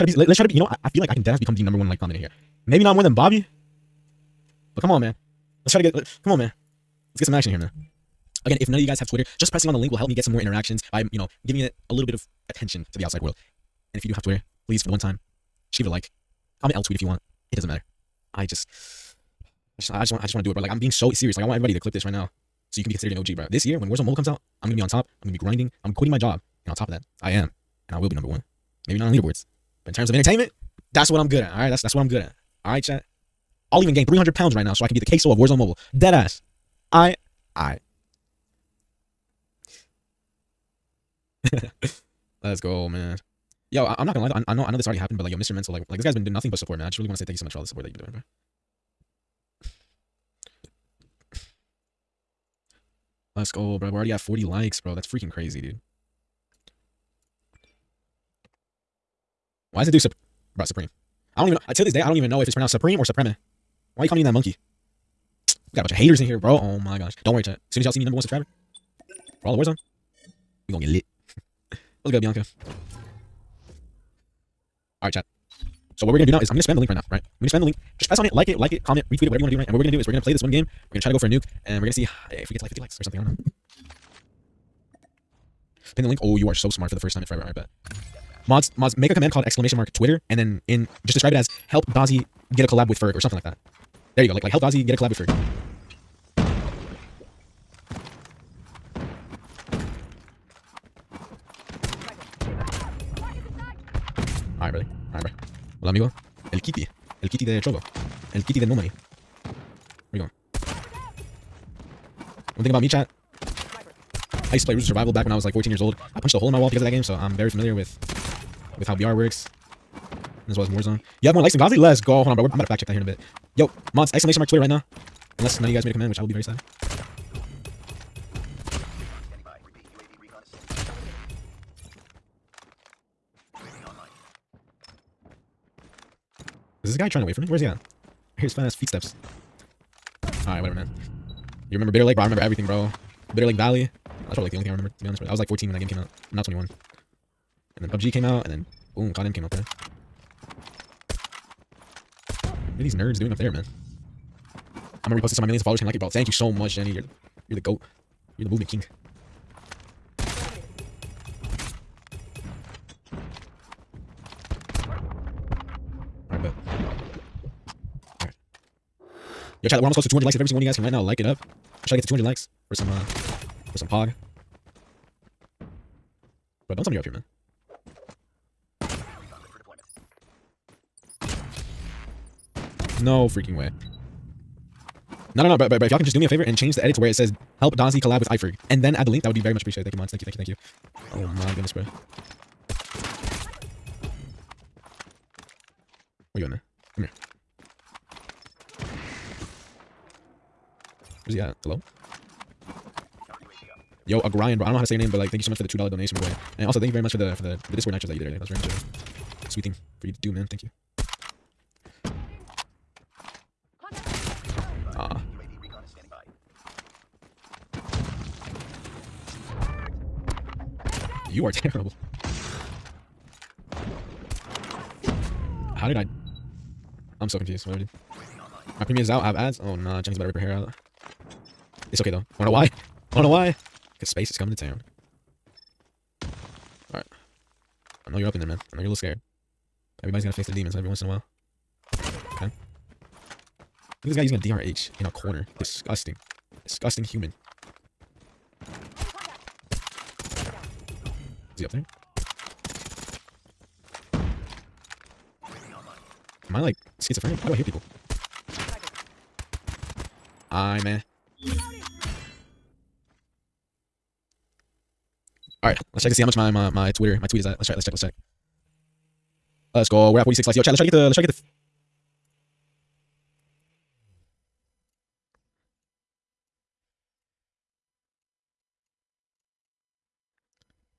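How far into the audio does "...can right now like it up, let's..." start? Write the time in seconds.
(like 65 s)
170 s.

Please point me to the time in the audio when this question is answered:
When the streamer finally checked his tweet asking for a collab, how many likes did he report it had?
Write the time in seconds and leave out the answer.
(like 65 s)
270 s.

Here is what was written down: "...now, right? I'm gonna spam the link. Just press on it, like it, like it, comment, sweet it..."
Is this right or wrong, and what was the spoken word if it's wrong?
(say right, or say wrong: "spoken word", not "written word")
wrong: "retweet", not "sweet".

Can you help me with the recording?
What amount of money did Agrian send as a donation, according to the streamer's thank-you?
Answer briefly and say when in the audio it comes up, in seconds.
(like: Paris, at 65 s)
$2, at 205 s.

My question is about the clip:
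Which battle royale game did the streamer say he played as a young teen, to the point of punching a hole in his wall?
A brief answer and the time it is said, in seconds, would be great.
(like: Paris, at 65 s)
Rules of Survival, at 114 s.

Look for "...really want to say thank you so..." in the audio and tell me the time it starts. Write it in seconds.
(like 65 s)
46 s.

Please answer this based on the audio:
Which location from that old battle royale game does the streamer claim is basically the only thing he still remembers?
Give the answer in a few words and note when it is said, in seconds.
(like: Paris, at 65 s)
Bitter Lake Valley, at 143 s.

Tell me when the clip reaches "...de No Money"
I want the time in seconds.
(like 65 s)
108 s.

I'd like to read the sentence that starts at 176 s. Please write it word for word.
Bro, don't tell me you're up here, man.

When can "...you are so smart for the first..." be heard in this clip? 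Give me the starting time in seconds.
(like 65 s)
86 s.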